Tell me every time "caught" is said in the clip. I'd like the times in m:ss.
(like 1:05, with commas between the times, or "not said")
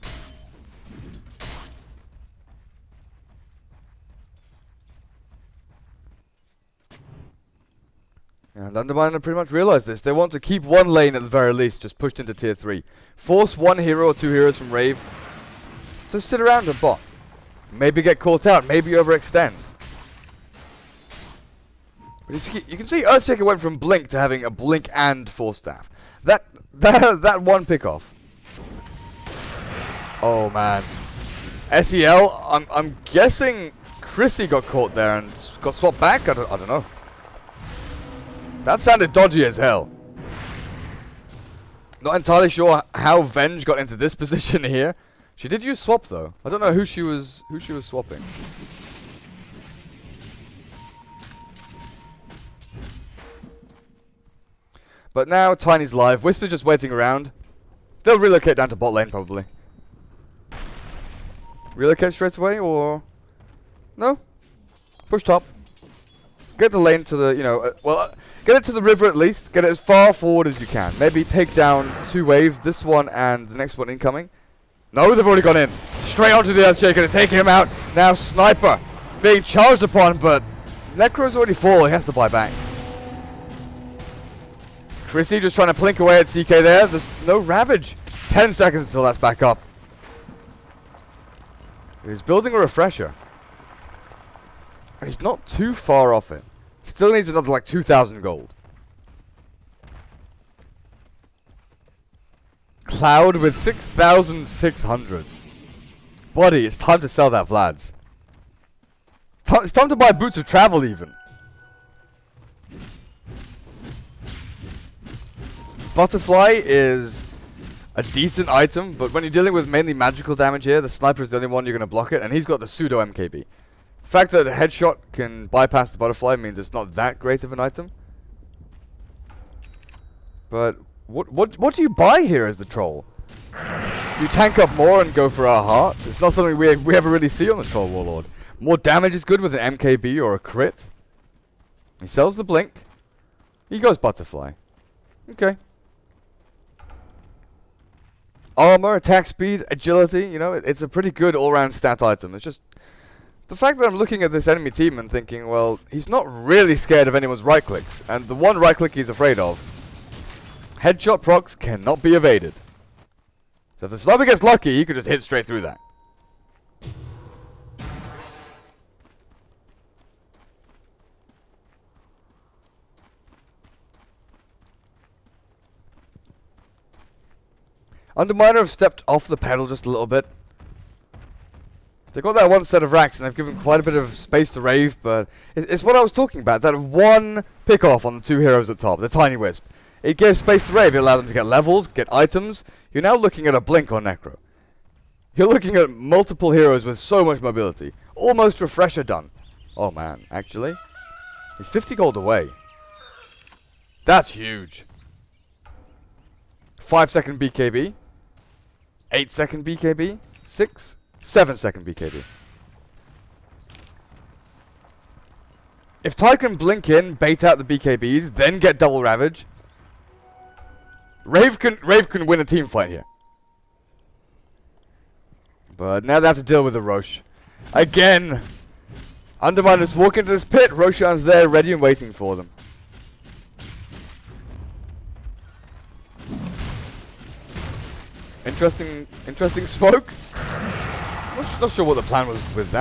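0:18, 0:34.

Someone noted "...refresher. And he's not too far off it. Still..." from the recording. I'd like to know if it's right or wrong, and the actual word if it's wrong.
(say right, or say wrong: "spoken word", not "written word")
right.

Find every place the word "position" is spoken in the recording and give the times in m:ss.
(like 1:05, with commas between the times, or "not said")
0:44.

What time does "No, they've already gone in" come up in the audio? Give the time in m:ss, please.
1:14.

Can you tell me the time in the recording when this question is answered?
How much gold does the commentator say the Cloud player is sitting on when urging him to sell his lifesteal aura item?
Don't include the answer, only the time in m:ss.
1:43.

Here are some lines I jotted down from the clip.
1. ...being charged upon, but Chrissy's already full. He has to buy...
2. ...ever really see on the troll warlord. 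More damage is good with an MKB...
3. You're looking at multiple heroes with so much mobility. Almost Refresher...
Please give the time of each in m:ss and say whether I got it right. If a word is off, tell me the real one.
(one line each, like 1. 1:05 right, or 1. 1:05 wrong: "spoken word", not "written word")
1. 1:19 wrong: "Necro", not "Chrissy"
2. 2:16 right
3. 3:15 right.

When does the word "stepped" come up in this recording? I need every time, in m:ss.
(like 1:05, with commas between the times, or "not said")
2:58.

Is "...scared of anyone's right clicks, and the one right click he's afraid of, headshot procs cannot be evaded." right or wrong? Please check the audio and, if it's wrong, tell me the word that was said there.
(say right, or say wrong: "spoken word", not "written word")
right.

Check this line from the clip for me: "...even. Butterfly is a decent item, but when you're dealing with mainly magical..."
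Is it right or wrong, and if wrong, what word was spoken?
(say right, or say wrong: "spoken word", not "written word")
right.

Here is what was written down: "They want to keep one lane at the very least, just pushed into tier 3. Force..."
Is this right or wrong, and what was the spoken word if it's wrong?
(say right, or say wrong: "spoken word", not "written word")
right.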